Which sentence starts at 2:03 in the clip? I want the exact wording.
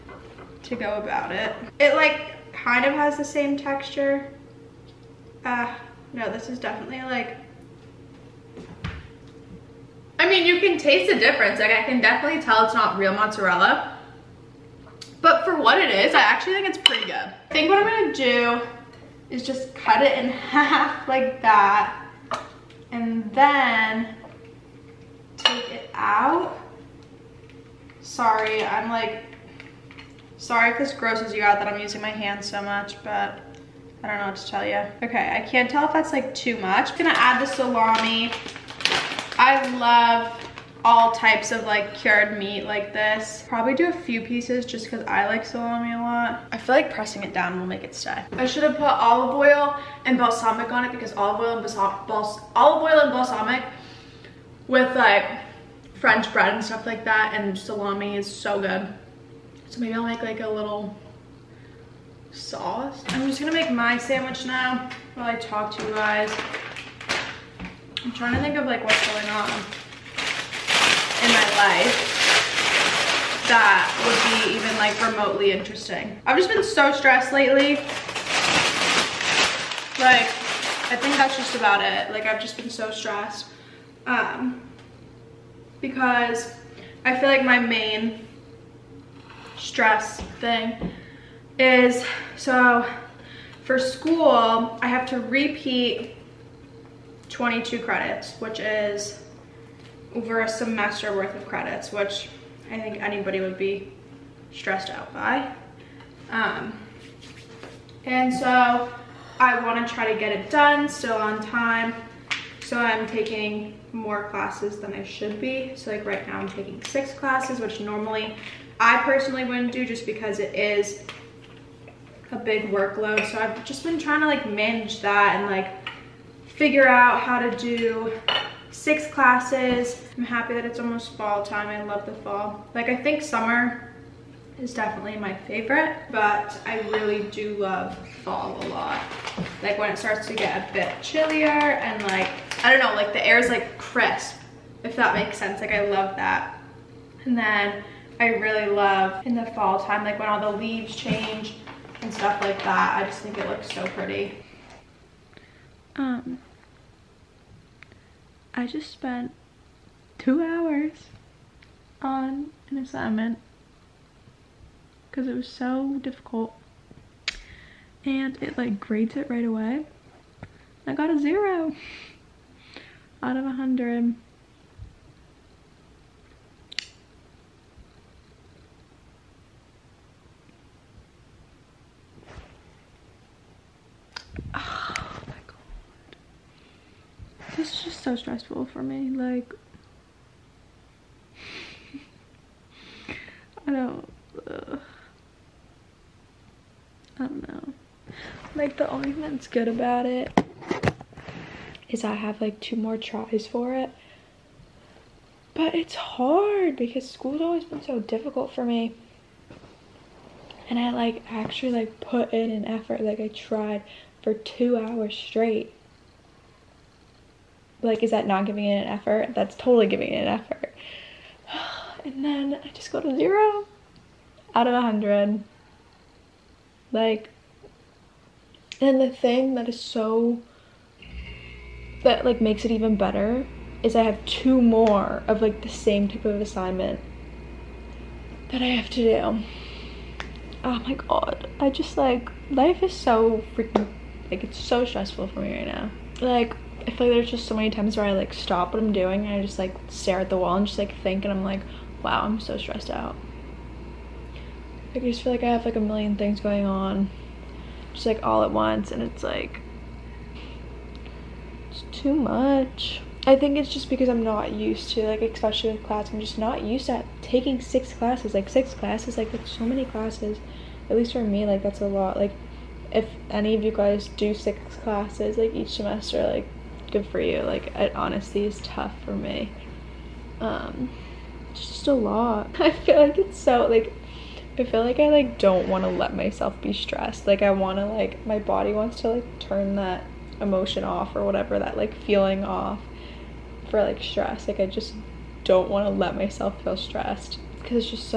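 So I've just been trying to like manage that and like figure out how to do six classes.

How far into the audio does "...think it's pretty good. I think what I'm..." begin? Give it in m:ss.
0:16.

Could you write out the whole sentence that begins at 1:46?
Um, and so I want to try to get it done, still on time.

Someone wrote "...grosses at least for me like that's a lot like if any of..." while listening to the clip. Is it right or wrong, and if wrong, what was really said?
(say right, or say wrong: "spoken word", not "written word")
wrong: "classes", not "grosses".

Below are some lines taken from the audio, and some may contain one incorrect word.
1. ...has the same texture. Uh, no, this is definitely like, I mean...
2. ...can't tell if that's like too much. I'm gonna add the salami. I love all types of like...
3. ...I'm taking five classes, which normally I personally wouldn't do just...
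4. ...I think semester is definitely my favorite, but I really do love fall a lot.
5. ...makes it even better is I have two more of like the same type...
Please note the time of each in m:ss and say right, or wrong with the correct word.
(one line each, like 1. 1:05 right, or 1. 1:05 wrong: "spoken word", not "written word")
1. 0:02 right
2. 0:35 right
3. 1:56 wrong: "six", not "five"
4. 2:12 wrong: "summer", not "semester"
5. 3:52 right.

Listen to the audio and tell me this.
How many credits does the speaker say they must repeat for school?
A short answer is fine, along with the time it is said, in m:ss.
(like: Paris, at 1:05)
22, at 1:37.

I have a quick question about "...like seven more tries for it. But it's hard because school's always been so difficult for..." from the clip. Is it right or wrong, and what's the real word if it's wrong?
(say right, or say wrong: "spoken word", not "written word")
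wrong: "two", not "seven".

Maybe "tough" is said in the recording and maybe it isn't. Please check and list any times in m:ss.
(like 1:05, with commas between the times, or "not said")
4:38.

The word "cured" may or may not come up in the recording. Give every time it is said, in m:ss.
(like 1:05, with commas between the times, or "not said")
0:41.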